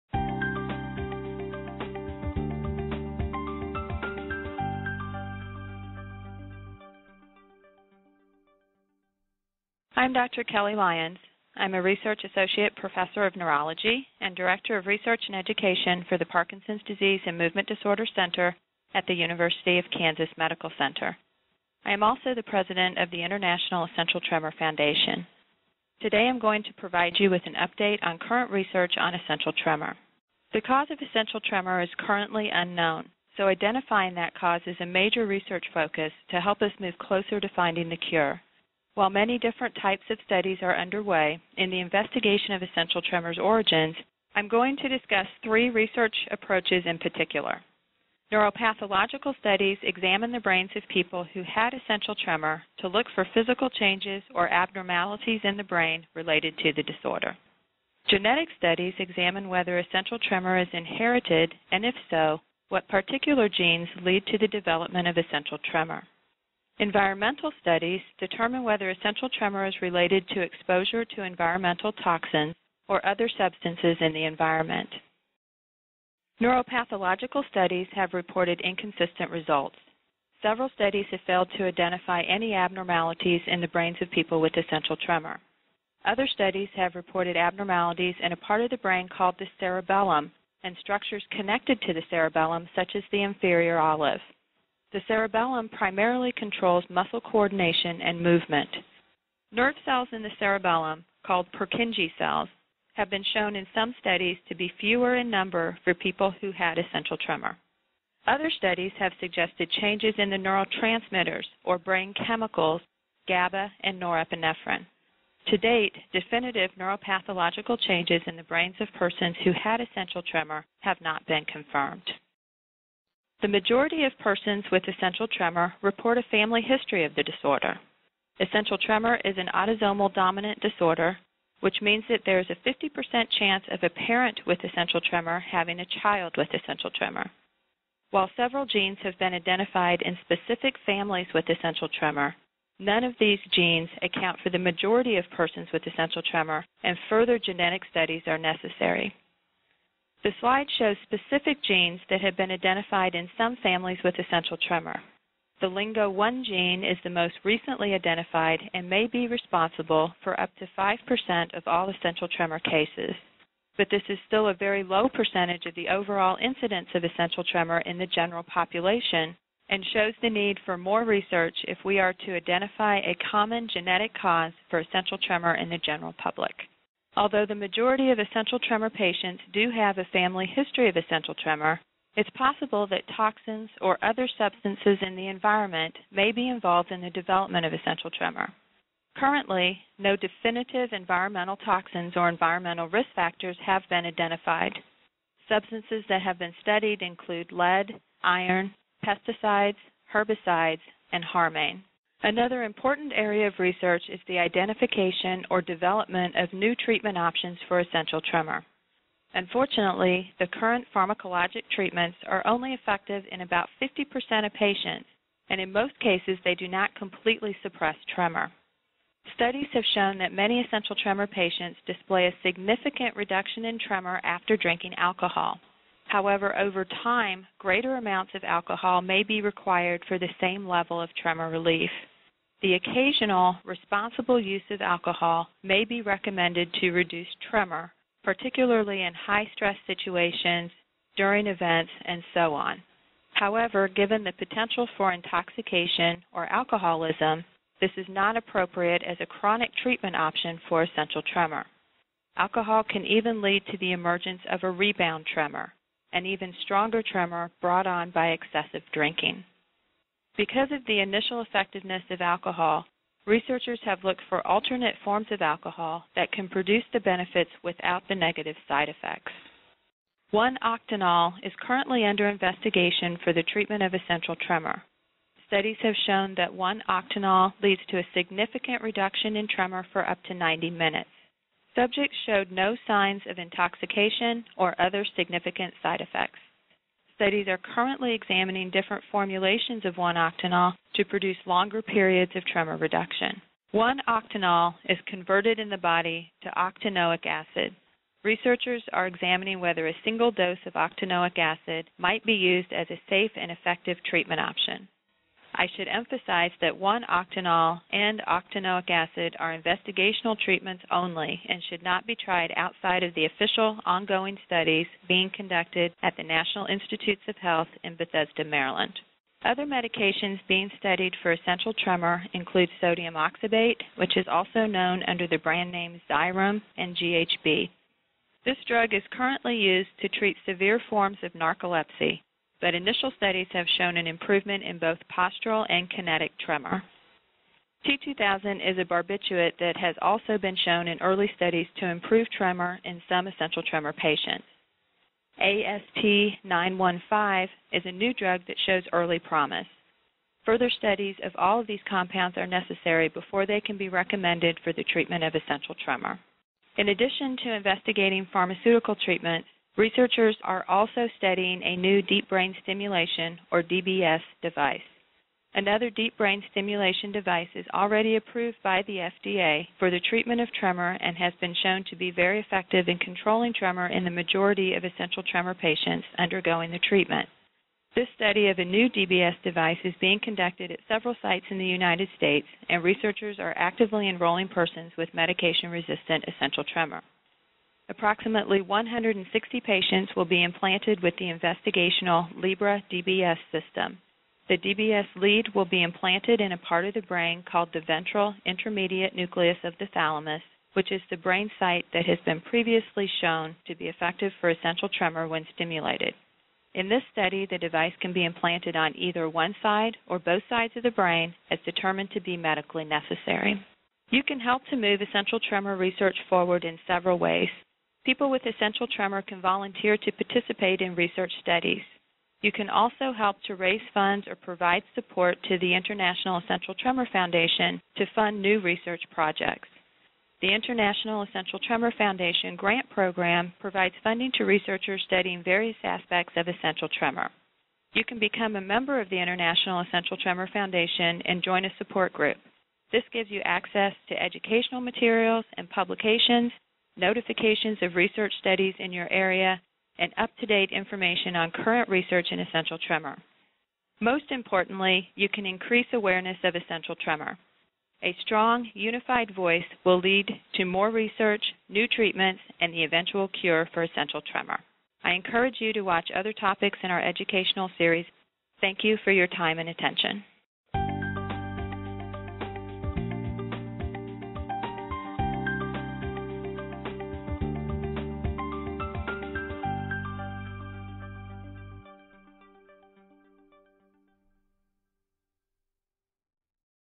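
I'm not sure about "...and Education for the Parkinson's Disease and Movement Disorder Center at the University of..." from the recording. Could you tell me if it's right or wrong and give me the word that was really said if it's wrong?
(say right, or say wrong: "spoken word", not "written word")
right.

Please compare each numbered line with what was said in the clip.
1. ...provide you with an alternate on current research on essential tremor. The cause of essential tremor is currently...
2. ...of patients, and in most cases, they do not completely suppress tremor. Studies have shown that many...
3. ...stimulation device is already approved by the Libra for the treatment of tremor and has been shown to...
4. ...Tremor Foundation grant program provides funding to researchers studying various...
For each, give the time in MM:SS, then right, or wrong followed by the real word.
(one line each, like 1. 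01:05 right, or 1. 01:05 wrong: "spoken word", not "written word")
1. 00:26 wrong: "update", not "alternate"
2. 03:34 right
3. 06:06 wrong: "FDA", not "Libra"
4. 07:11 right.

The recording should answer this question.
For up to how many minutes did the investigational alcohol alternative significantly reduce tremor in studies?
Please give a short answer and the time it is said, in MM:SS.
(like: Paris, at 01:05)
90 minutes, at 04:40.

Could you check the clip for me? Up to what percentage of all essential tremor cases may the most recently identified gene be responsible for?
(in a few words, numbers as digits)
5%.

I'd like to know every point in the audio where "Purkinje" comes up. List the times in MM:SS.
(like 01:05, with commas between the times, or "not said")
01:41.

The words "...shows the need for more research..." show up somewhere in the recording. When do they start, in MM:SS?
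02:49.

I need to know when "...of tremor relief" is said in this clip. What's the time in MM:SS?
03:51.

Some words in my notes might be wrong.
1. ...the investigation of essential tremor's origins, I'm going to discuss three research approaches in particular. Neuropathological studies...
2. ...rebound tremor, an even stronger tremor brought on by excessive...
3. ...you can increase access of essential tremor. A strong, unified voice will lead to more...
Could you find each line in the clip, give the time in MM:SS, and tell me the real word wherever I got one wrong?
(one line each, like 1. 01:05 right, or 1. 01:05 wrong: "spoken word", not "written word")
1. 00:41 right
2. 04:14 right
3. 07:35 wrong: "awareness", not "access".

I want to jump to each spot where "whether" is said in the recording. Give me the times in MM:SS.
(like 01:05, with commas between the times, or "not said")
00:59, 01:08, 04:59.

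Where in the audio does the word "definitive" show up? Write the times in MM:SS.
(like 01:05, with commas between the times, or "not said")
01:56, 03:10.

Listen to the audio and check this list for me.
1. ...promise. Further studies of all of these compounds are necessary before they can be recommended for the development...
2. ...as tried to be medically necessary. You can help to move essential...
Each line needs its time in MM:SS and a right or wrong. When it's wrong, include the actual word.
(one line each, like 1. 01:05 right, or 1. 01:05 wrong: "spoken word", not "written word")
1. 05:49 wrong: "treatment", not "development"
2. 06:51 wrong: "determined", not "tried".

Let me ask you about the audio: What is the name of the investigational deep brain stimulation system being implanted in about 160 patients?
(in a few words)
Libra DBS system.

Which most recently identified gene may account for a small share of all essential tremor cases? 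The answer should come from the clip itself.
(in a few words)
LINGO1.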